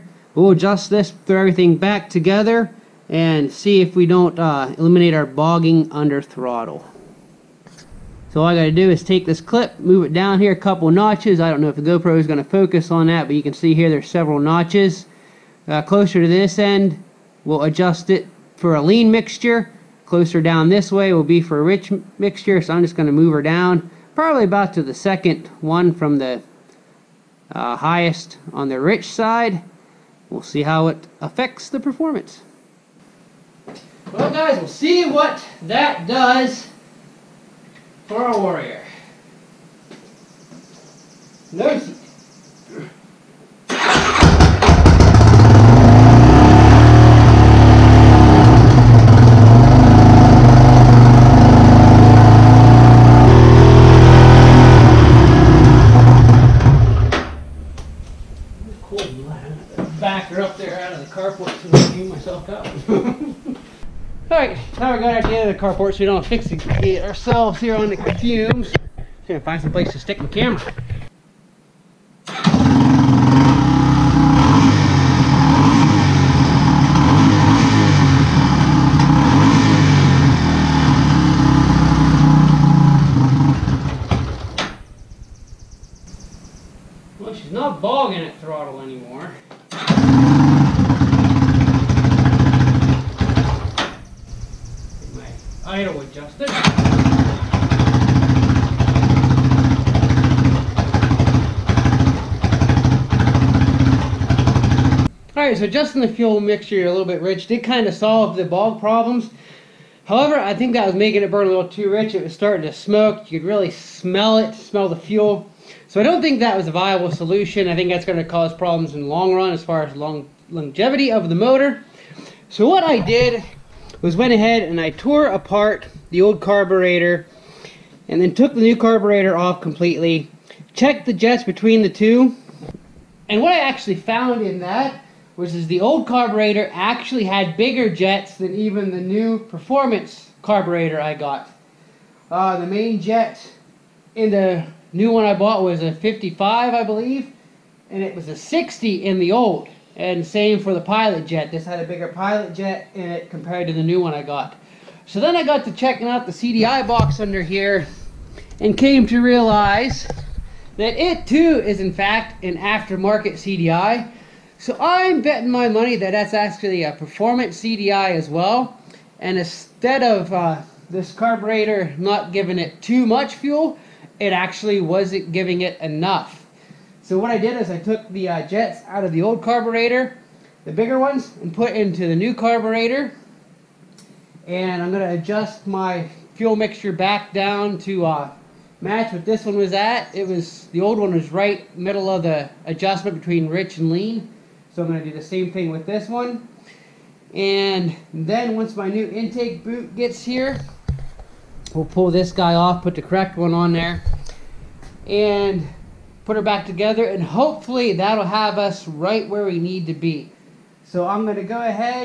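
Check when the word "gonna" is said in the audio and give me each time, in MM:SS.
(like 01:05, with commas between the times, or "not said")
00:12, 00:22, 01:09.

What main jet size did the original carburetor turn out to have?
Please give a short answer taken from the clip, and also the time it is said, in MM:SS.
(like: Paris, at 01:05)
60, at 02:28.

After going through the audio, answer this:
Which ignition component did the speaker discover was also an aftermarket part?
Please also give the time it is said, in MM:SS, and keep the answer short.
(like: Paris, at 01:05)
CDI box, at 02:36.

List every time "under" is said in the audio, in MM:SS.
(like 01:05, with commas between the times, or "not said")
00:05, 02:37.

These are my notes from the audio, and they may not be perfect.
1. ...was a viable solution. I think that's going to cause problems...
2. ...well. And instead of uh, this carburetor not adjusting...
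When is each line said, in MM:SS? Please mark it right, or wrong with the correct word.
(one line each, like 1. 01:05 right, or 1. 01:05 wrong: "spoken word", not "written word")
1. 01:56 right
2. 02:48 wrong: "giving", not "adjusting".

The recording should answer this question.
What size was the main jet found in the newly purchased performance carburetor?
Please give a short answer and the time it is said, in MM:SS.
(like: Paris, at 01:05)
55, at 02:25.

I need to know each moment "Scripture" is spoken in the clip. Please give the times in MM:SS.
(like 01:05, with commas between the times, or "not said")
not said.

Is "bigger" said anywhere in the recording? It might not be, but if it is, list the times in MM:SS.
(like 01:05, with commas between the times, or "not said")
02:17, 02:31, 03:00.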